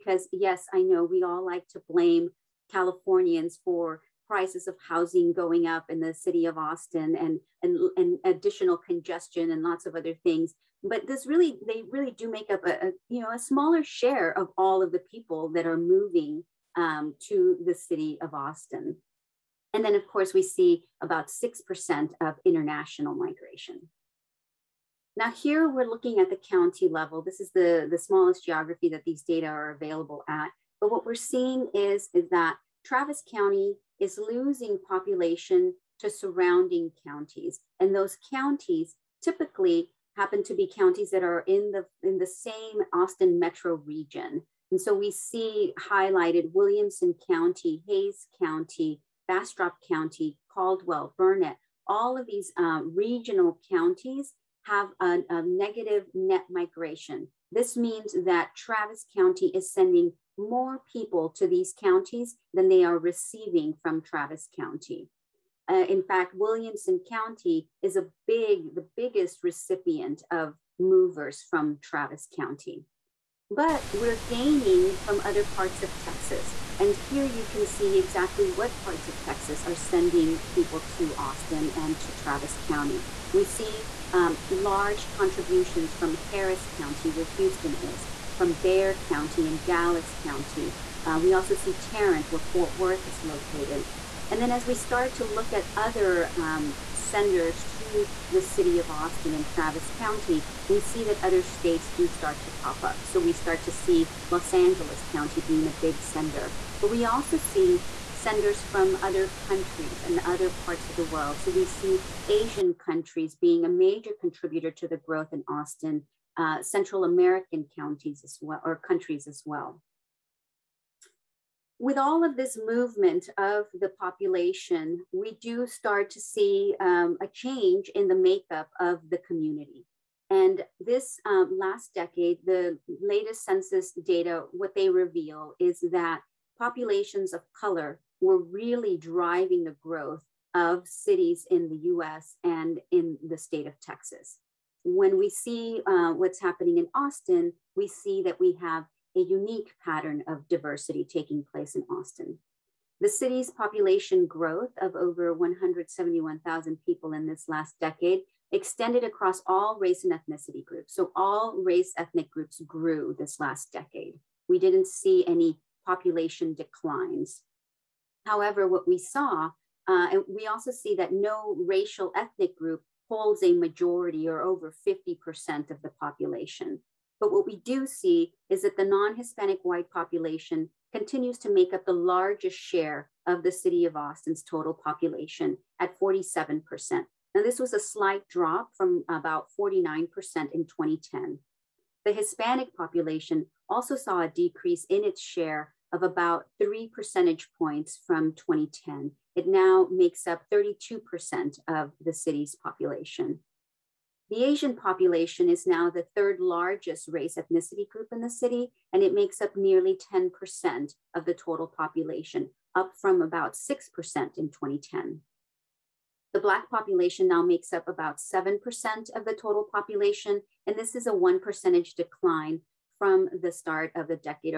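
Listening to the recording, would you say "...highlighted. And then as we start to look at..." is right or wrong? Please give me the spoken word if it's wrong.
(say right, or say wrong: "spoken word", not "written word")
wrong: "located", not "highlighted".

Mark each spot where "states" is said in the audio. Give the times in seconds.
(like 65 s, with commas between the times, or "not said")
101 s, 143 s.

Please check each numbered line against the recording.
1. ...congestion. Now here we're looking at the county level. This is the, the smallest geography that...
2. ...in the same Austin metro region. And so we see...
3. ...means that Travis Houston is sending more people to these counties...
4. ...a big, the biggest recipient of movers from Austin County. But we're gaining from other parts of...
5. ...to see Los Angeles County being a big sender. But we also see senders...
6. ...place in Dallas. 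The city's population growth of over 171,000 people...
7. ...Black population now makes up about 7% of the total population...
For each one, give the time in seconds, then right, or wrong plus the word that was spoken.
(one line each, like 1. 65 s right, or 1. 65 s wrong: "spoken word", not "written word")
1. 23 s wrong: "migration", not "congestion"
2. 42 s right
3. 57 s wrong: "County", not "Houston"
4. 67 s wrong: "Travis", not "Austin"
5. 103 s right
6. 151 s wrong: "Austin", not "Dallas"
7. 216 s right.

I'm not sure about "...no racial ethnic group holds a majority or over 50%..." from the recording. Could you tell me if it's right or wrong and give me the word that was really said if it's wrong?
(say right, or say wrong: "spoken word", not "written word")
right.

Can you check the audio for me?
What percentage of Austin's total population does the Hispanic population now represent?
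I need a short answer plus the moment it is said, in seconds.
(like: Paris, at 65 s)
32%, at 200 s.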